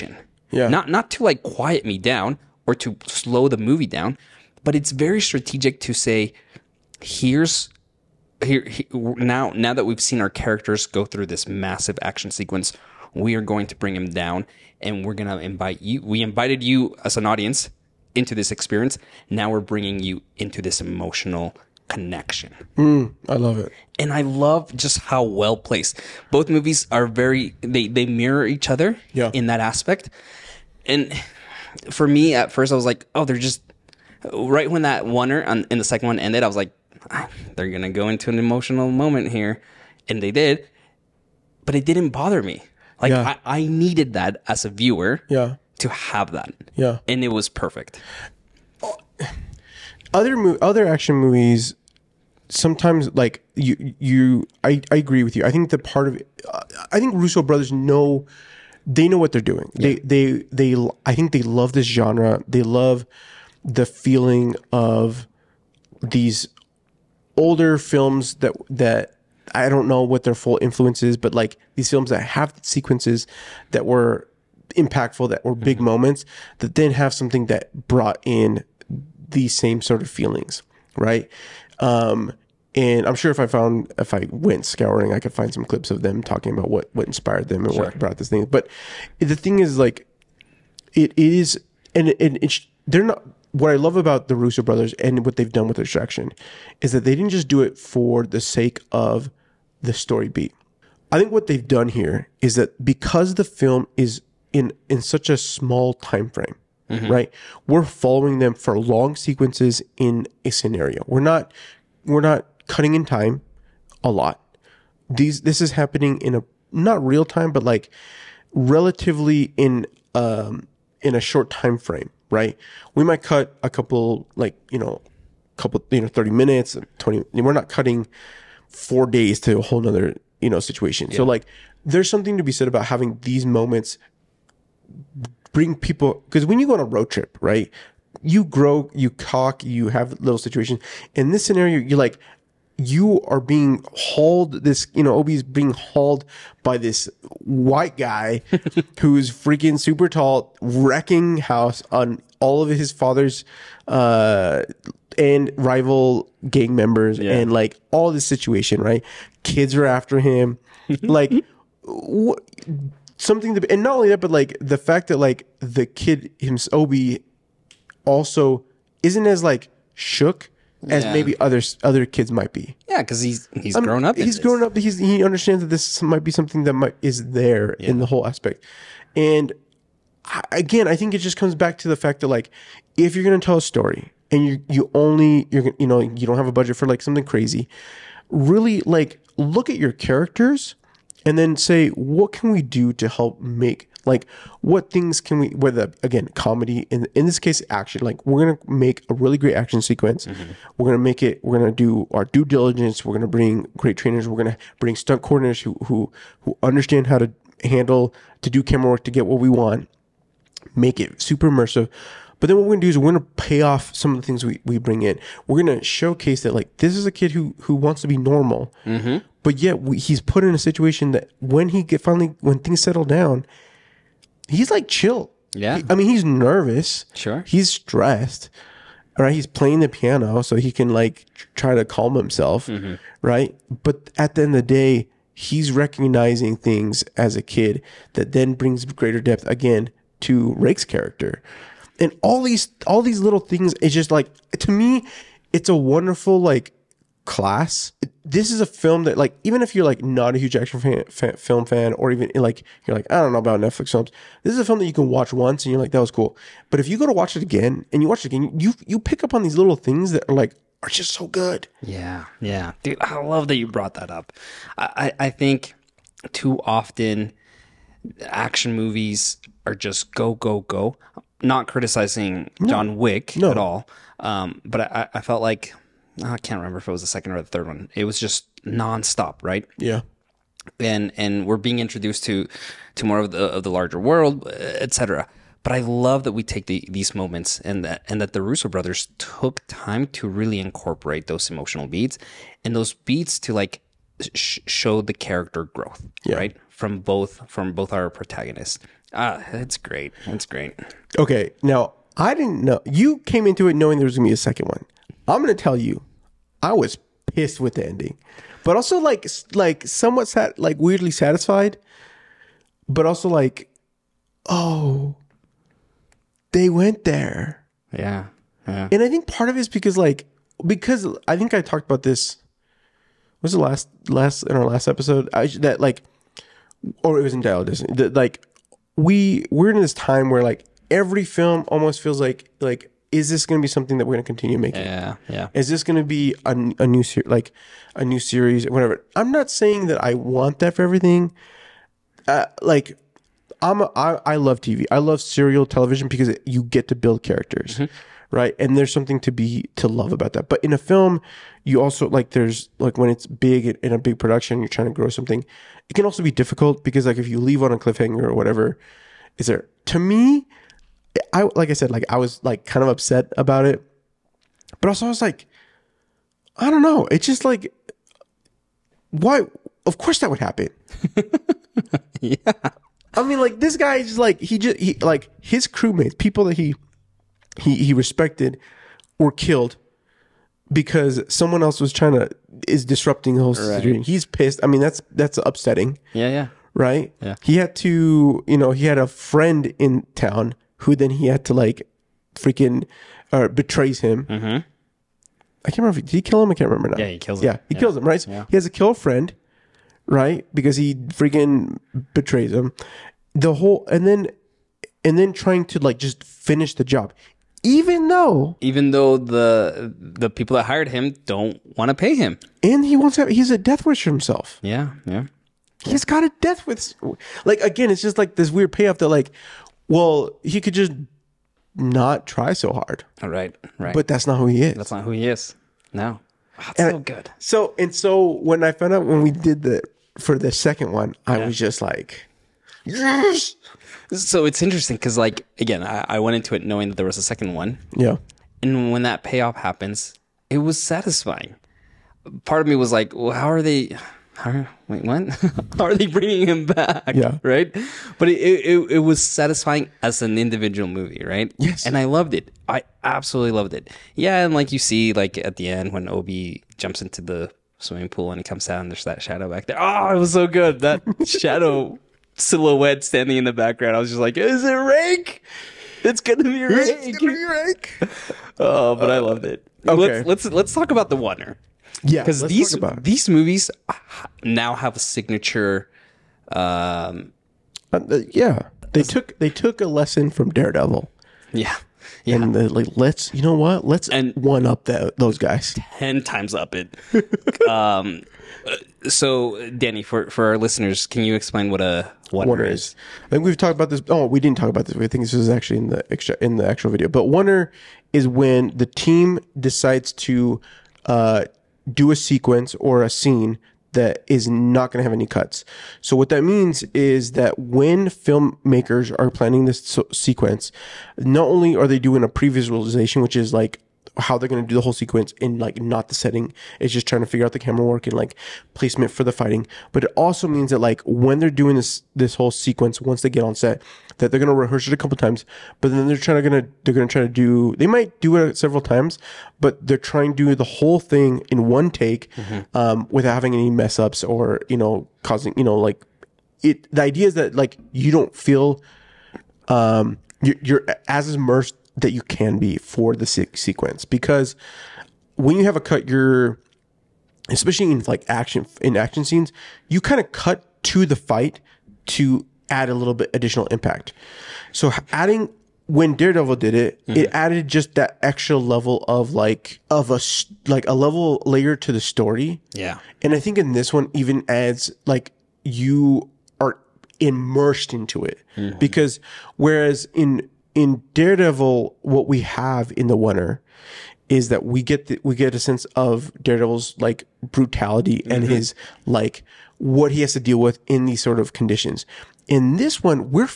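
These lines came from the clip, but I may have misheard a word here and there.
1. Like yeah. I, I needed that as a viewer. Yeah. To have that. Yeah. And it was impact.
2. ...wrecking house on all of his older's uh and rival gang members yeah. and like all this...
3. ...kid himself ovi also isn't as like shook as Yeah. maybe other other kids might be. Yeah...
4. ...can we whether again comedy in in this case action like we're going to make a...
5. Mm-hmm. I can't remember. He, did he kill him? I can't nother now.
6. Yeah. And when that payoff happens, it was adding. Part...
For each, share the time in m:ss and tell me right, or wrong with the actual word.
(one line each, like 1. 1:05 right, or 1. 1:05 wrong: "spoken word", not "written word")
1. 0:43 wrong: "perfect", not "impact"
2. 2:30 wrong: "father", not "older"
3. 2:45 right
4. 3:15 right
5. 6:34 wrong: "remember", not "nother"
6. 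7:17 wrong: "satisfying", not "adding".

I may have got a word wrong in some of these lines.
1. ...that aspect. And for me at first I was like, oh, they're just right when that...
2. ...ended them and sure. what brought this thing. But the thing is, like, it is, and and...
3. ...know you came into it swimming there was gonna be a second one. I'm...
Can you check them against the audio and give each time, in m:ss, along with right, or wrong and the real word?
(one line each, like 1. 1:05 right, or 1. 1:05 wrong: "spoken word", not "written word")
1. 0:29 right
2. 1:27 wrong: "inspired", not "ended"
3. 5:02 wrong: "knowing", not "swimming".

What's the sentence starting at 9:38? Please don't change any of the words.
his like what he has to deal with in these sort of conditions.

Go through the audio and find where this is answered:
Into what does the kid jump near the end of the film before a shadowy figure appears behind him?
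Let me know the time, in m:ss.
7:37.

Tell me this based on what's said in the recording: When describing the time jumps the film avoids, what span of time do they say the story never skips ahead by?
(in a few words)
4 days.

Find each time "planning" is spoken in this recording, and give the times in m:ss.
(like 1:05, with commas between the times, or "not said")
8:29.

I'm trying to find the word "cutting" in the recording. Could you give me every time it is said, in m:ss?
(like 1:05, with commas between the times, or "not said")
1:52, 2:07.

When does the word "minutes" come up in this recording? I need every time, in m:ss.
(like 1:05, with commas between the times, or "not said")
2:06.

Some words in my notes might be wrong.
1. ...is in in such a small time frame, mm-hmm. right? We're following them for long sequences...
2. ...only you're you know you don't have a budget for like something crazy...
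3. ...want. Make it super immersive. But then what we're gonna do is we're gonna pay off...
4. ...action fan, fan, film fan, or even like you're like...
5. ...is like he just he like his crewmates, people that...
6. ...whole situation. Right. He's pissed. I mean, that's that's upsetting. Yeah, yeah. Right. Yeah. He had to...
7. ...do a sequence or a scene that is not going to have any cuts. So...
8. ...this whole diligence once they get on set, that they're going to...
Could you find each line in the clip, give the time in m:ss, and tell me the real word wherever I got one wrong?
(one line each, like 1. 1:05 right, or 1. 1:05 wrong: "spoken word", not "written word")
1. 1:43 right
2. 3:04 right
3. 3:29 right
4. 4:10 right
5. 6:13 right
6. 6:23 right
7. 8:21 right
8. 8:42 wrong: "sequence", not "diligence".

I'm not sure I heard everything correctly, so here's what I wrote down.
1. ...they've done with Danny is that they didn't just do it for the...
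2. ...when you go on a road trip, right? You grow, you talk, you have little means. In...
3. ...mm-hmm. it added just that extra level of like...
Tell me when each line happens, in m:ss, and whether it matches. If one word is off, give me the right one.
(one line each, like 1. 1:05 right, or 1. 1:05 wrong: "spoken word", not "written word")
1. 1:35 wrong: "Extraction", not "Danny"
2. 2:16 wrong: "situations", not "means"
3. 9:17 right.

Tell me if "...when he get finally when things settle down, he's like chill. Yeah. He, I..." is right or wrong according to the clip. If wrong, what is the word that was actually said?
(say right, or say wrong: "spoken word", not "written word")
right.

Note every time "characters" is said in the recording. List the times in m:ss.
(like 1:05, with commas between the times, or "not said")
0:10, 3:09, 4:00, 4:55, 5:47.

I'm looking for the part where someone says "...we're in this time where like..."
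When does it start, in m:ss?
5:29.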